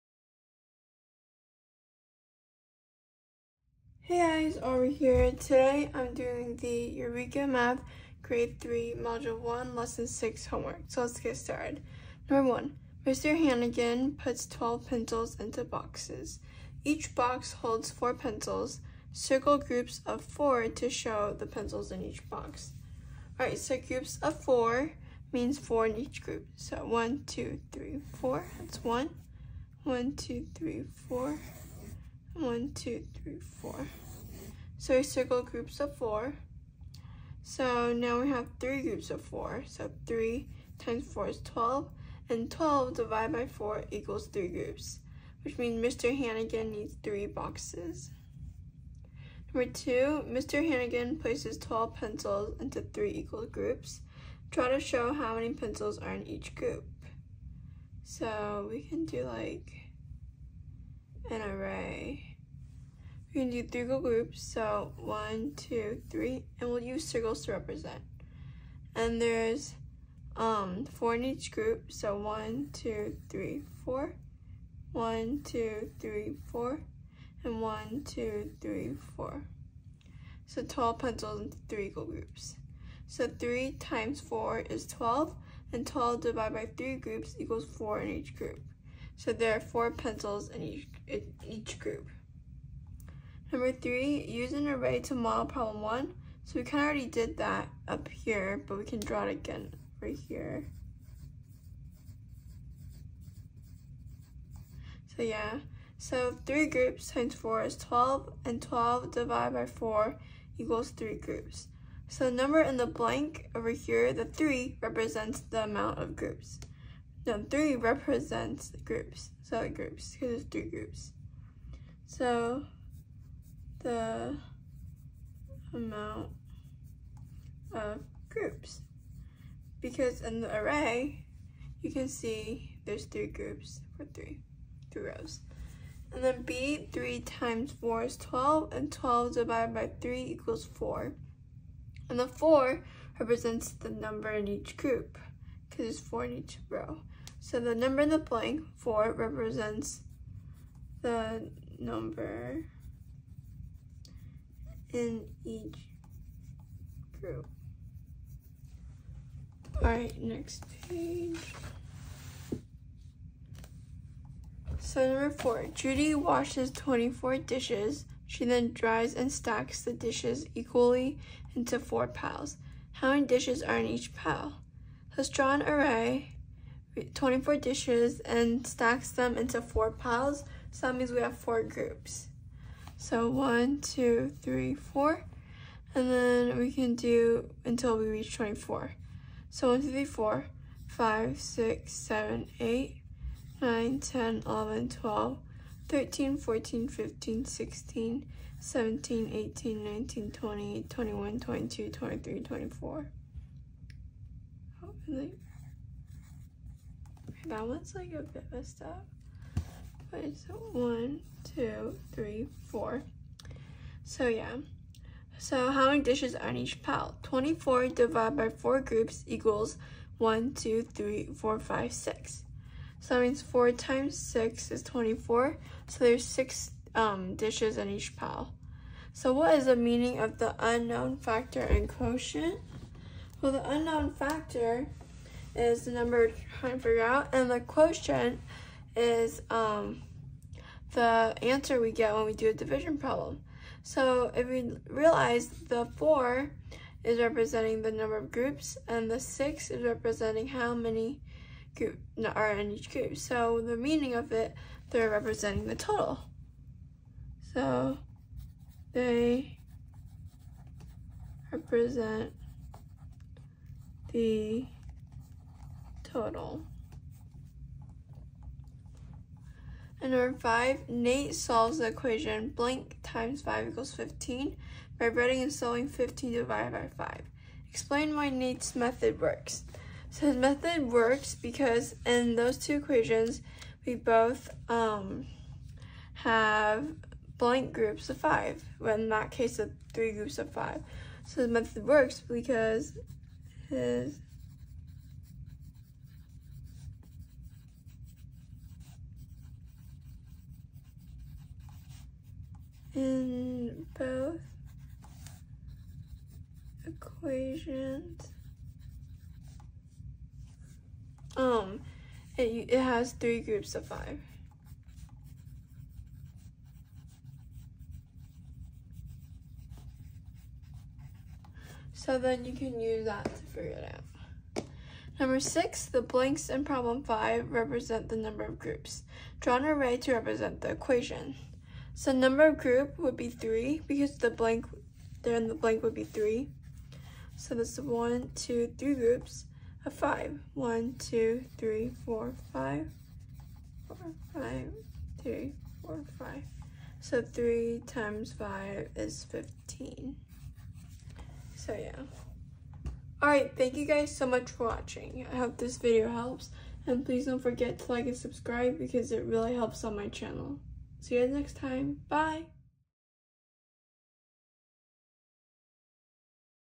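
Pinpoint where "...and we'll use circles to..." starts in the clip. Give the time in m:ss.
1:06.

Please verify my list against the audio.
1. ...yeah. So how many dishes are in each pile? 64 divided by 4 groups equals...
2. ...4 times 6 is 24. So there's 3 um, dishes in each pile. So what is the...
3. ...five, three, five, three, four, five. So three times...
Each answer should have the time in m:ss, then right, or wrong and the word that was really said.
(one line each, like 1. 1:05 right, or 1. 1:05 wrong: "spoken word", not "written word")
1. 3:34 wrong: "24", not "64"
2. 3:43 wrong: "6", not "3"
3. 5:42 wrong: "four", not "three".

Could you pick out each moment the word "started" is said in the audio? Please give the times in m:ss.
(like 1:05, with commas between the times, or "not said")
0:11.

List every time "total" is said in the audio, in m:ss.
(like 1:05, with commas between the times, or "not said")
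4:15, 4:26.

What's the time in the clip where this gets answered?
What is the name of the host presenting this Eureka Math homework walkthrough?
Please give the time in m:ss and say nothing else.
0:04.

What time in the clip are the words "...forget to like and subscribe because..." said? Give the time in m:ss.
5:57.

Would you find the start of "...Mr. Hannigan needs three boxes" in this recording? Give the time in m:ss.
0:45.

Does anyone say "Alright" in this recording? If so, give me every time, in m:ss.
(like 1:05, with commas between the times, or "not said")
0:23, 2:39, 5:53.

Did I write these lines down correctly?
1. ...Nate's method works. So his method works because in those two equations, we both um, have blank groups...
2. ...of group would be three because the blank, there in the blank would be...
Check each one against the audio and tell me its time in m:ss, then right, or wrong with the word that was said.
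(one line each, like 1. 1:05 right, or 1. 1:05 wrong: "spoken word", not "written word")
1. 4:38 right
2. 5:32 right.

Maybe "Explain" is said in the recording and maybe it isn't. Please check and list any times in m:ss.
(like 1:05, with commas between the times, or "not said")
4:37.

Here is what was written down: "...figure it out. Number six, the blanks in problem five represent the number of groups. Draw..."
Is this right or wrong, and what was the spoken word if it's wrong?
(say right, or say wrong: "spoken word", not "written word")
right.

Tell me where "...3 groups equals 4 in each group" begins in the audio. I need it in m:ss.
1:26.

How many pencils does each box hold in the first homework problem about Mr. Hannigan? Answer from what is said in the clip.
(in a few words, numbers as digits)
4.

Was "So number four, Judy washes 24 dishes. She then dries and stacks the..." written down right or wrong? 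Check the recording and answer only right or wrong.
right.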